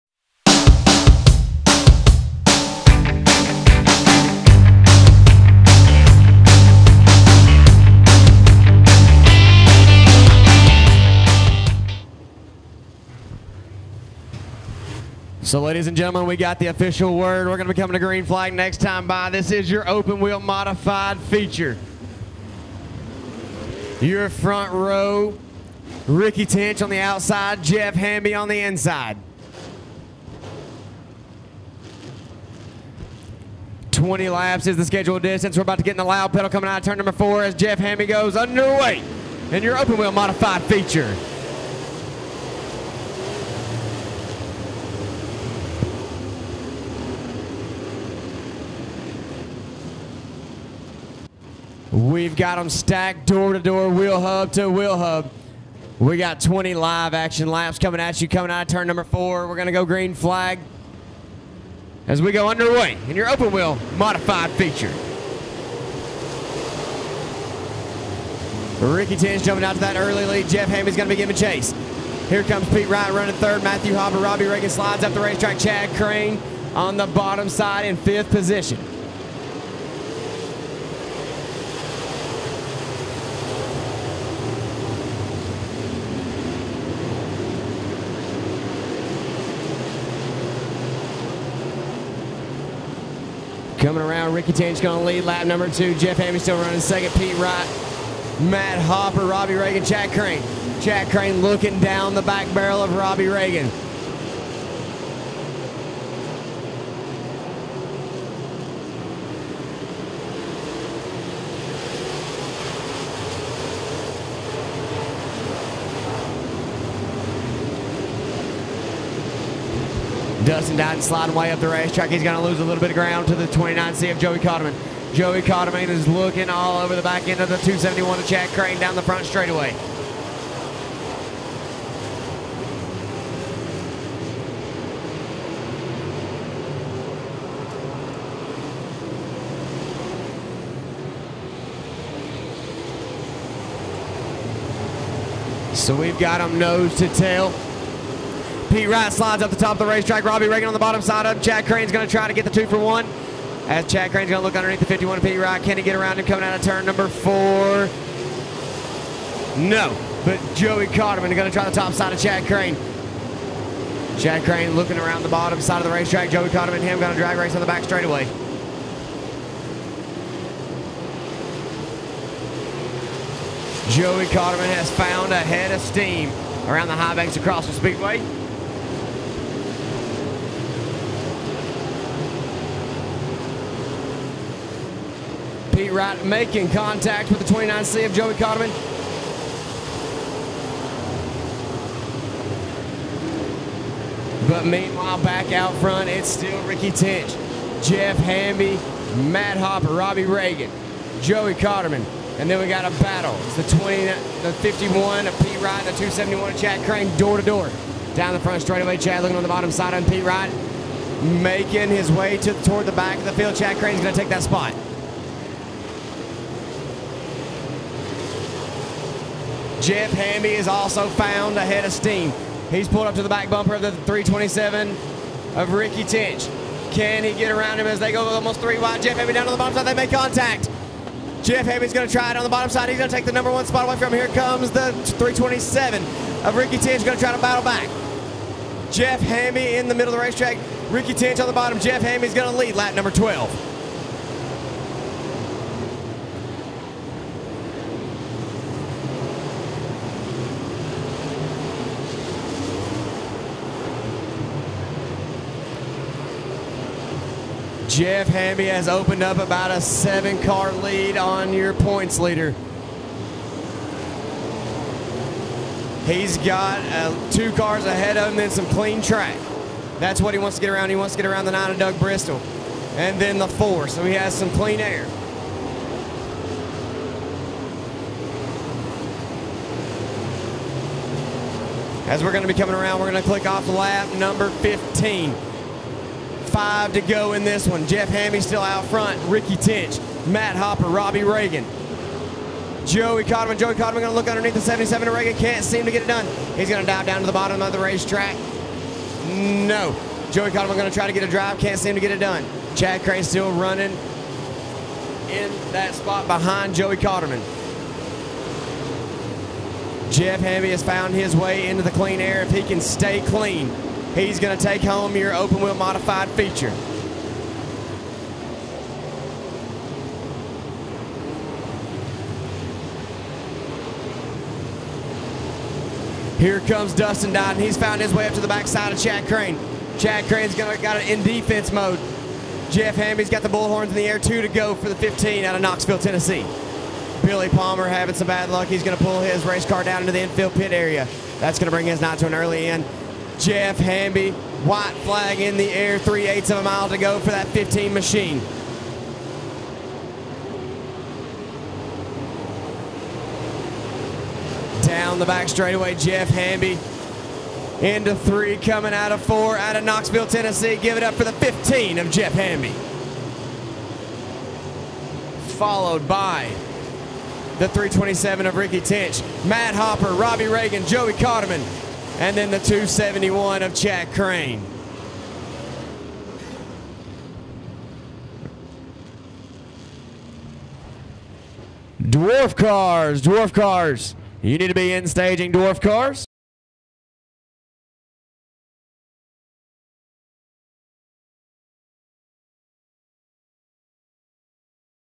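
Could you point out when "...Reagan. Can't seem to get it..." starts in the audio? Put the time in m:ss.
4:55.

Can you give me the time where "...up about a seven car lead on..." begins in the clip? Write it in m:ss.
4:19.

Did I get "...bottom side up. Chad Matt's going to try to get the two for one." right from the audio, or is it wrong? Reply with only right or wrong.
wrong.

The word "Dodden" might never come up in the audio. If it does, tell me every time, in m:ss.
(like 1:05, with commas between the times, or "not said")
5:27.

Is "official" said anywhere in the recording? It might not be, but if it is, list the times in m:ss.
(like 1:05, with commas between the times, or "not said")
0:16.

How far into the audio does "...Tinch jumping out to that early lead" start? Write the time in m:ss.
1:09.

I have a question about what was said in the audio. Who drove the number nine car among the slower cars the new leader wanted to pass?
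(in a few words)
Doug Bristol.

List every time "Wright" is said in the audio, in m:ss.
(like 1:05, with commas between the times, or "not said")
1:37, 2:28, 2:35, 3:05, 3:25, 3:30.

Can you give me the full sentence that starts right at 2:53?
Joey Cotterman has found a head of steam around the high banks across the speedway.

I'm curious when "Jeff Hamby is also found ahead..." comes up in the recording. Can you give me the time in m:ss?
3:39.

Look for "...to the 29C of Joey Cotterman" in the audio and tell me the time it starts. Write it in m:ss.
2:03.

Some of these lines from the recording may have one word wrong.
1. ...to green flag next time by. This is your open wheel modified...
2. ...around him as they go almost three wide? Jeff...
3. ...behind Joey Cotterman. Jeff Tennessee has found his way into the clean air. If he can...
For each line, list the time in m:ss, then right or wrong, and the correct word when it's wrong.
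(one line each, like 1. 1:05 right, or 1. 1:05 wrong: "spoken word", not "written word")
1. 0:17 right
2. 3:47 right
3. 5:06 wrong: "Hamby", not "Tennessee".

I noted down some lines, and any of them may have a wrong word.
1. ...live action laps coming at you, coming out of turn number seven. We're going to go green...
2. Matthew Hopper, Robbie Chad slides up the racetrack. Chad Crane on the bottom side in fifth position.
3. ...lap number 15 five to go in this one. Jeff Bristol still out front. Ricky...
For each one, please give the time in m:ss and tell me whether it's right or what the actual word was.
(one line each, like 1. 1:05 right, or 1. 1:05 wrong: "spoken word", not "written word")
1. 0:56 wrong: "four", not "seven"
2. 1:13 wrong: "Reagan", not "Chad"
3. 4:43 wrong: "Hamby", not "Bristol".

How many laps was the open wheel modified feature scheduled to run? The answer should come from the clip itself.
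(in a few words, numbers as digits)
20.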